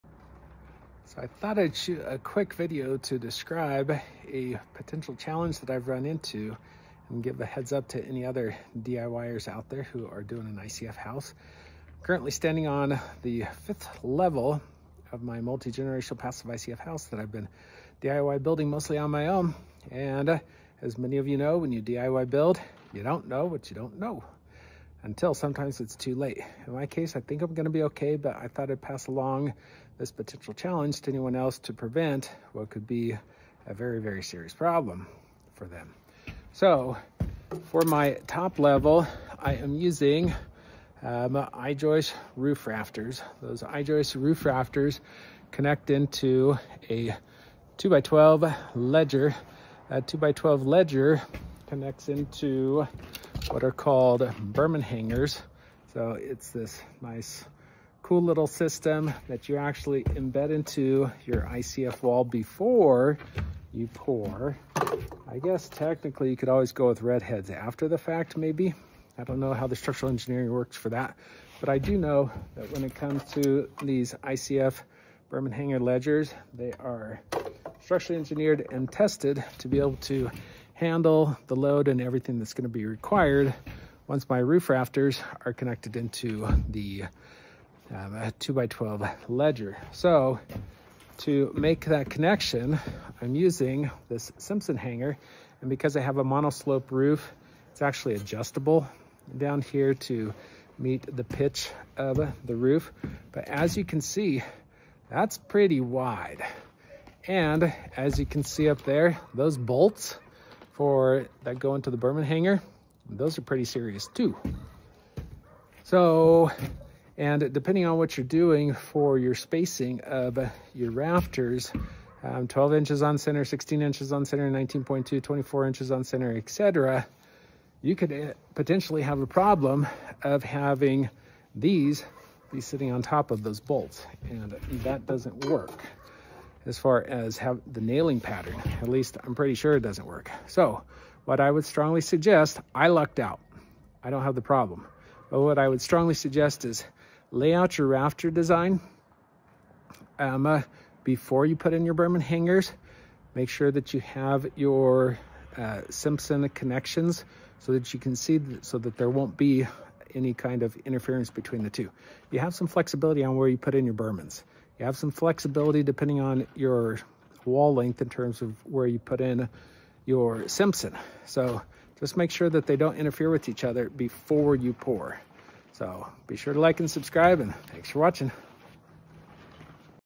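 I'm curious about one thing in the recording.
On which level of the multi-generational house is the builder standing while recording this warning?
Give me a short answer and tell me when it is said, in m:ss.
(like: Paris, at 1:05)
fifth, at 0:13.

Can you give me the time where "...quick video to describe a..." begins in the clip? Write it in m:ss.
0:02.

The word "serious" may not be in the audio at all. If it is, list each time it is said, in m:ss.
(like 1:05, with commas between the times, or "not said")
0:34, 1:53.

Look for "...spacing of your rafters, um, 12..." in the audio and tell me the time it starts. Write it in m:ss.
1:59.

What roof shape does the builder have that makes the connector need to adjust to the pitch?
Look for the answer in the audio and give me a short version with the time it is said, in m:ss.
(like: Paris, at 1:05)
monoslope, at 1:36.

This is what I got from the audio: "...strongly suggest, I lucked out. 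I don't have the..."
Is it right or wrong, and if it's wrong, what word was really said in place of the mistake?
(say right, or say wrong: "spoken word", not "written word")
right.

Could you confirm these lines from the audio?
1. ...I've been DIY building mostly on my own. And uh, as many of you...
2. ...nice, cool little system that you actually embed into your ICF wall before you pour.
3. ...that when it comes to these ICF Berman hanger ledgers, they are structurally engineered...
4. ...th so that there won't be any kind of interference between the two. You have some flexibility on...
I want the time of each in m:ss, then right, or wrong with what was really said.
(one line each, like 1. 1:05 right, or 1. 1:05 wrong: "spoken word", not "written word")
1. 0:17 right
2. 0:57 right
3. 1:12 right
4. 2:38 right.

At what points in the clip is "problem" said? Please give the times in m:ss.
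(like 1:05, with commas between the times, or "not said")
0:34, 2:09, 2:24.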